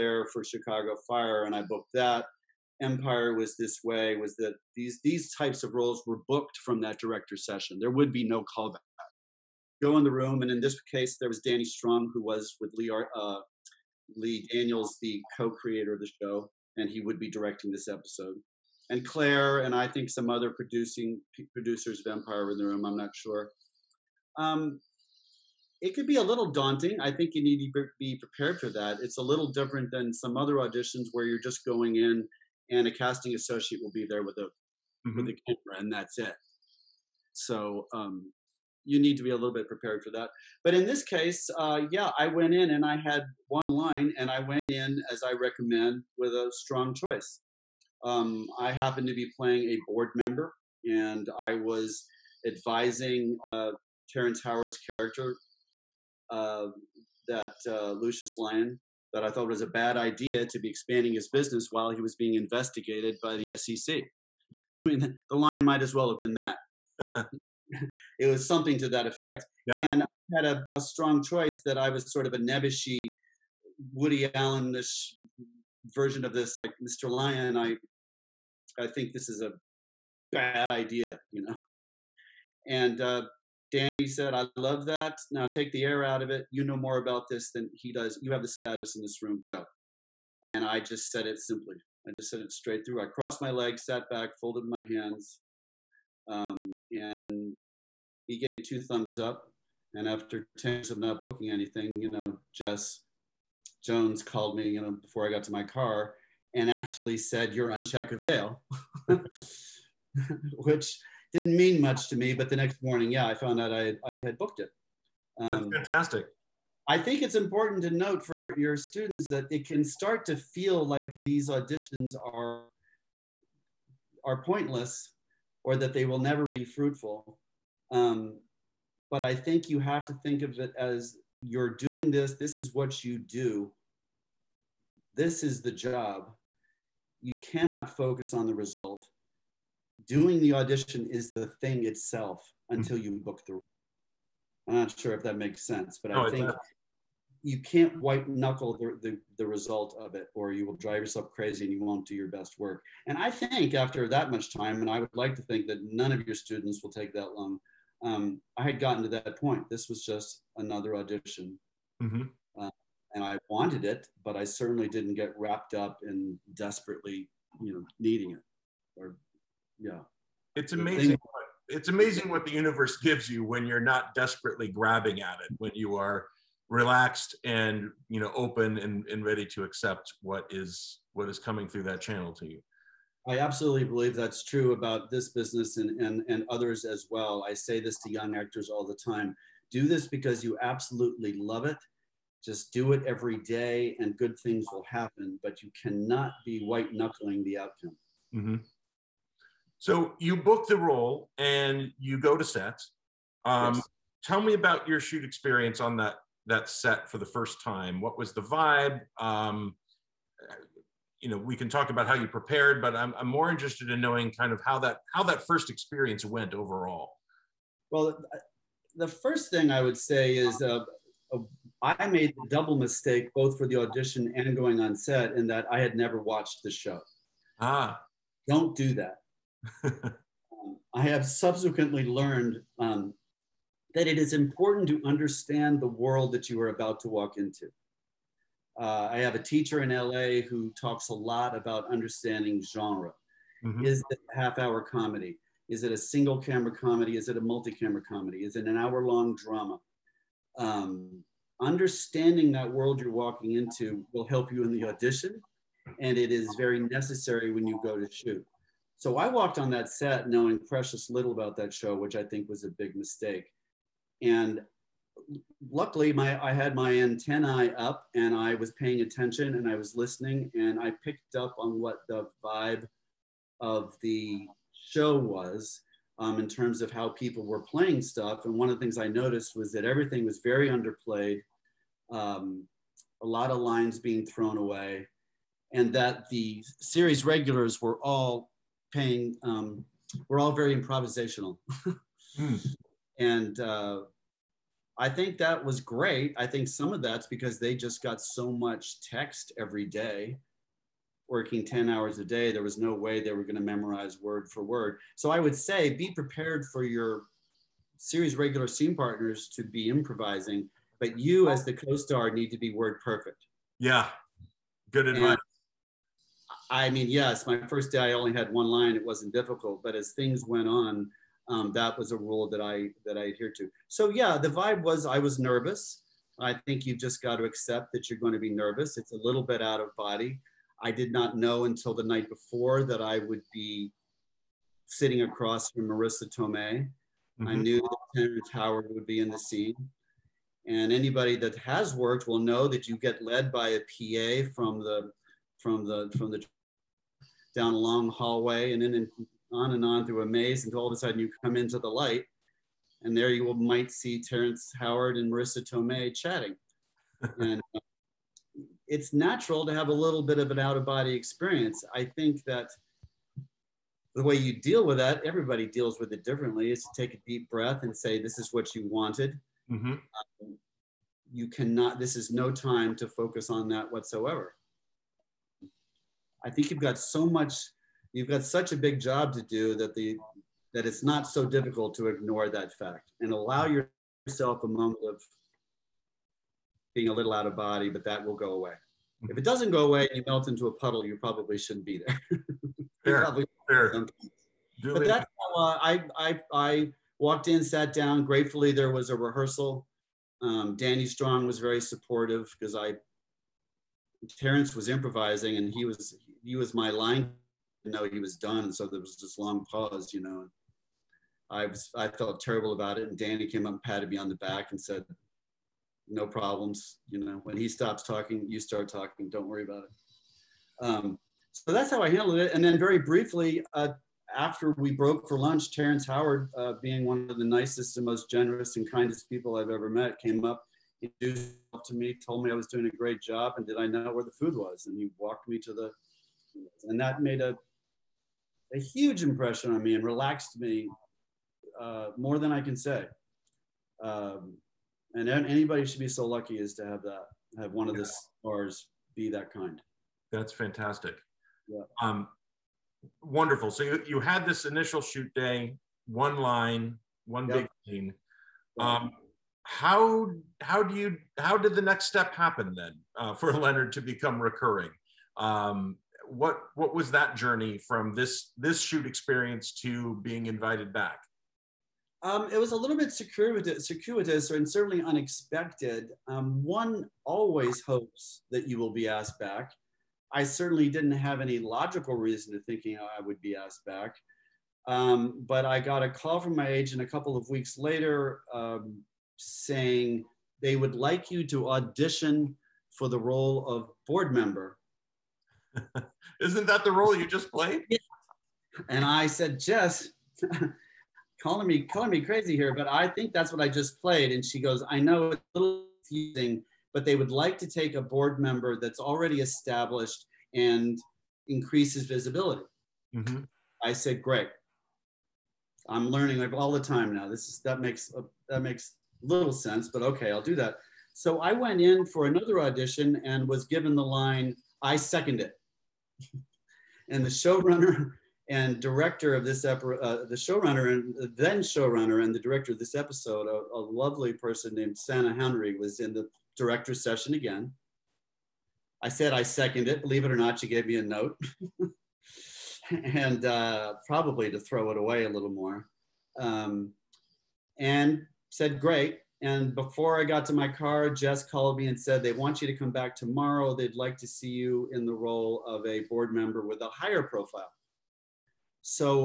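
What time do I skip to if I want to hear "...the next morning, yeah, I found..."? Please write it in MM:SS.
01:52.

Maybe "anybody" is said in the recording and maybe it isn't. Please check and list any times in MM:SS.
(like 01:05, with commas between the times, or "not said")
05:40, 07:25.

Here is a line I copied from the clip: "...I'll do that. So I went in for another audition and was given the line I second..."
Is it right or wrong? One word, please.
right.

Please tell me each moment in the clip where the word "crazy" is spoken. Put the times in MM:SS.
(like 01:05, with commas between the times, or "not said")
02:31, 08:22.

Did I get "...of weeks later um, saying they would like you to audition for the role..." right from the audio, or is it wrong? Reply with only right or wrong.
right.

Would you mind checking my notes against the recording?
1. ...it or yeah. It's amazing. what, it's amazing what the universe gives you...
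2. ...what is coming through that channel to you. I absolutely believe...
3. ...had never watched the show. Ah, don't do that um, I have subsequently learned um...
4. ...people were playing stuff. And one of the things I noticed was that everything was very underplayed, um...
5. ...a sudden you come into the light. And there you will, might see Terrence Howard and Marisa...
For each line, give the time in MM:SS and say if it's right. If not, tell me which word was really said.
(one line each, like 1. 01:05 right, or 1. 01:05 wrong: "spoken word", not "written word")
1. 02:48 right
2. 03:01 right
3. 03:45 right
4. 04:37 right
5. 05:50 right.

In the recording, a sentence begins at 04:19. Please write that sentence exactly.
So I walked on that set knowing precious little about that show, which I think was a big mistake.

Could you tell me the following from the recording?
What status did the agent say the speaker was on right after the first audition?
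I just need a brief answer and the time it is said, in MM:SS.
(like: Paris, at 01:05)
check avail, at 01:47.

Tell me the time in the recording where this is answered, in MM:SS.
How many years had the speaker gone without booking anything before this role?
01:40.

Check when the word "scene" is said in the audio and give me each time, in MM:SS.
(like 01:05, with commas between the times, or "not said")
05:08, 05:39, 07:37.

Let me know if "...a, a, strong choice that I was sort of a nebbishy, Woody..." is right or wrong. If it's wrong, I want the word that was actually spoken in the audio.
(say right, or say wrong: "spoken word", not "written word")
right.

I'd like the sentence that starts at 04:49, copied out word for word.
Um, we're all very improvisational, mm.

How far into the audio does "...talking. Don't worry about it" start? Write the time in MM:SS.
06:58.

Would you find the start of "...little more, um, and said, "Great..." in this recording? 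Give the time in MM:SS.
09:05.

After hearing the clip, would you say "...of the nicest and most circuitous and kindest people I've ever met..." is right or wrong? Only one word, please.
wrong.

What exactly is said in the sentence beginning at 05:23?
So yeah, the vibe was I was nervous.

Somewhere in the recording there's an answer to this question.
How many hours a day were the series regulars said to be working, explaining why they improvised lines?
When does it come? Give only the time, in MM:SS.
05:01.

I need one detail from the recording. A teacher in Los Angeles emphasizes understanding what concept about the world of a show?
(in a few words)
genre.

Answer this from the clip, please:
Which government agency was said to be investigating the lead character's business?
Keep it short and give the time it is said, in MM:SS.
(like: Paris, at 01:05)
SEC, at 01:03.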